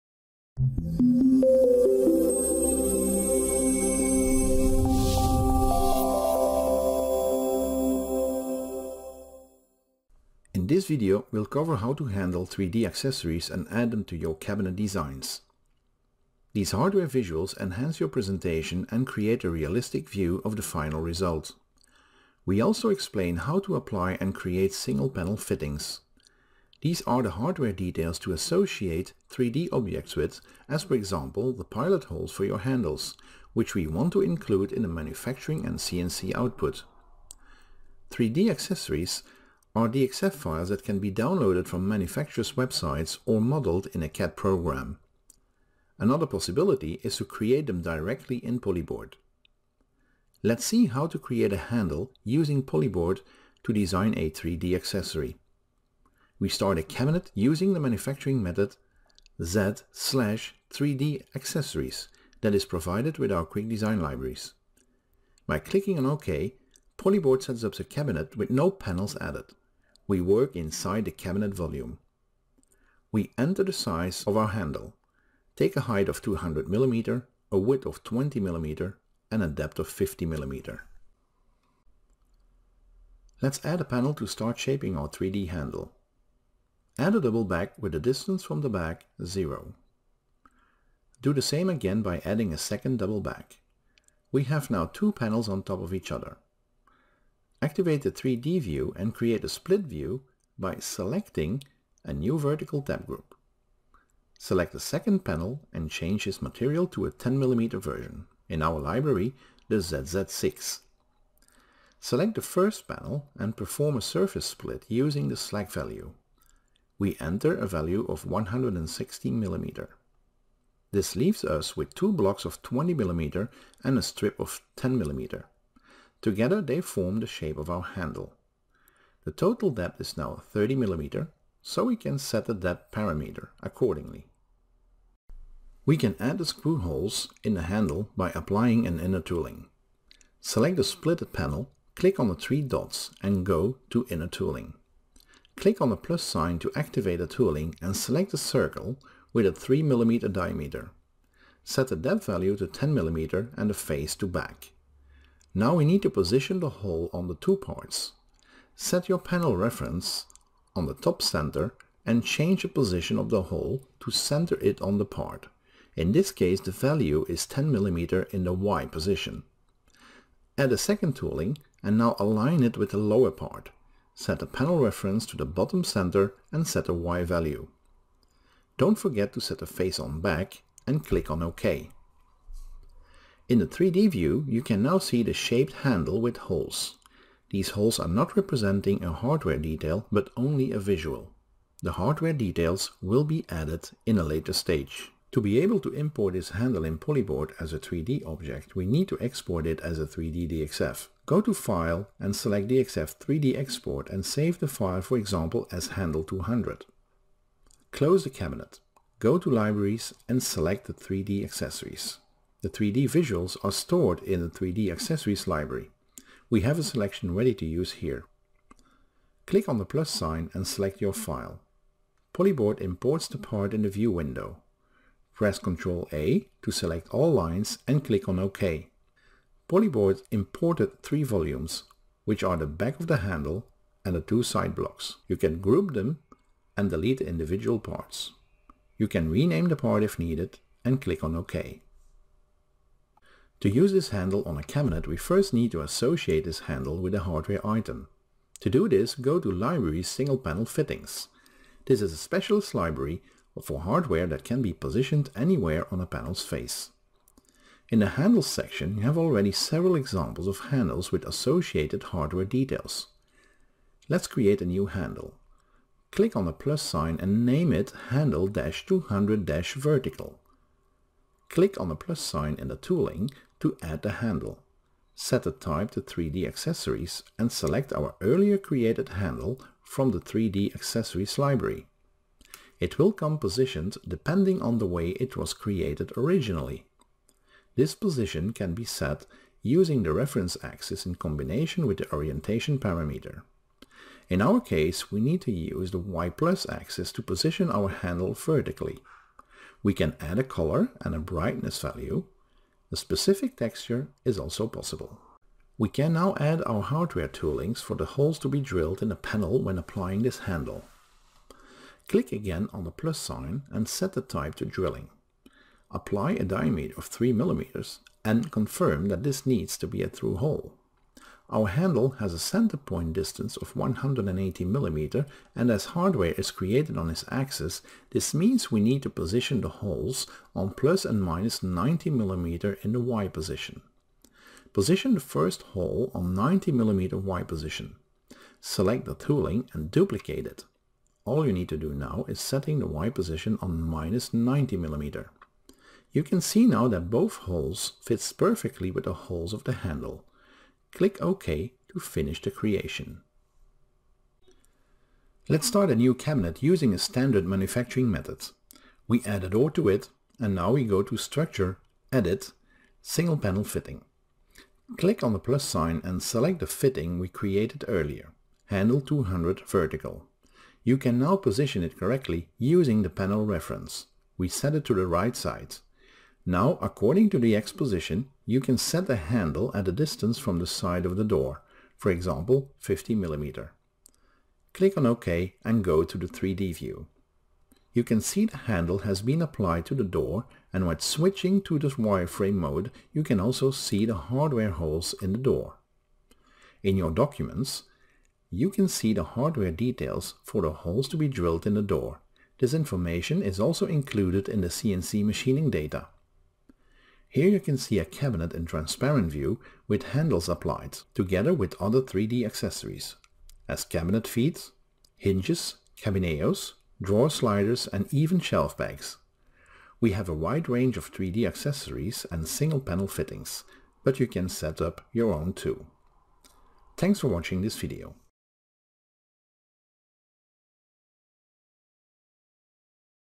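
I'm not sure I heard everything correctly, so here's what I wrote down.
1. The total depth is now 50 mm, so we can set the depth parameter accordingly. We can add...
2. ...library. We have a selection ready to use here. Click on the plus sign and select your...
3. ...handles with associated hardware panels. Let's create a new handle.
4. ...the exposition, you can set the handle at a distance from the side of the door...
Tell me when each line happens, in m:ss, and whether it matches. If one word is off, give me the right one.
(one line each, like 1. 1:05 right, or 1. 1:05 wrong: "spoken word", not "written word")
1. 2:09 wrong: "30", not "50"
2. 3:35 right
3. 4:20 wrong: "details", not "panels"
4. 6:17 right.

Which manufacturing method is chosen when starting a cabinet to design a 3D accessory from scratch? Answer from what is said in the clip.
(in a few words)
Z/3D accessories.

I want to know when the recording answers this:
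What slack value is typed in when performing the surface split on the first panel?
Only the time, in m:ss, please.
1:58.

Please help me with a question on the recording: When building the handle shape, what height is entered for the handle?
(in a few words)
200 mm.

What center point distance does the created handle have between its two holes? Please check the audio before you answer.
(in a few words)
180 mm.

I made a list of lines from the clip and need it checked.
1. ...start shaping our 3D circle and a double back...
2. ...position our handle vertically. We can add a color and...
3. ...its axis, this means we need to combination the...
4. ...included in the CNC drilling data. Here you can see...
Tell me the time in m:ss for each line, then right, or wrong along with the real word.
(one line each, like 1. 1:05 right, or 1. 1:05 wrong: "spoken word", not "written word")
1. 1:24 wrong: "handle", not "circle"
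2. 4:57 right
3. 5:27 wrong: "position", not "combination"
4. 6:43 wrong: "machining", not "drilling".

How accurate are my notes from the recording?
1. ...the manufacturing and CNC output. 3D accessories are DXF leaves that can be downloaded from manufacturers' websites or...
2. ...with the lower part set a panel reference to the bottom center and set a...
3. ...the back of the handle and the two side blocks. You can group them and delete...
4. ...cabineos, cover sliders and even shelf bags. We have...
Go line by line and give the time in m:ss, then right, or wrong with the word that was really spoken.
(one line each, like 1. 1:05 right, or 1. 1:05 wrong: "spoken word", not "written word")
1. 0:34 wrong: "files", not "leaves"
2. 2:52 right
3. 3:52 right
4. 6:55 wrong: "drawer", not "cover".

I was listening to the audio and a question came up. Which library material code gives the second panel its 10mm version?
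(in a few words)
ZZ6.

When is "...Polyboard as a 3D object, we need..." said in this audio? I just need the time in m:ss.
3:16.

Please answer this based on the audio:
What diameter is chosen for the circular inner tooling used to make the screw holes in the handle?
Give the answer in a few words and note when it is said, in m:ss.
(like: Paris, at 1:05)
3mm, at 2:29.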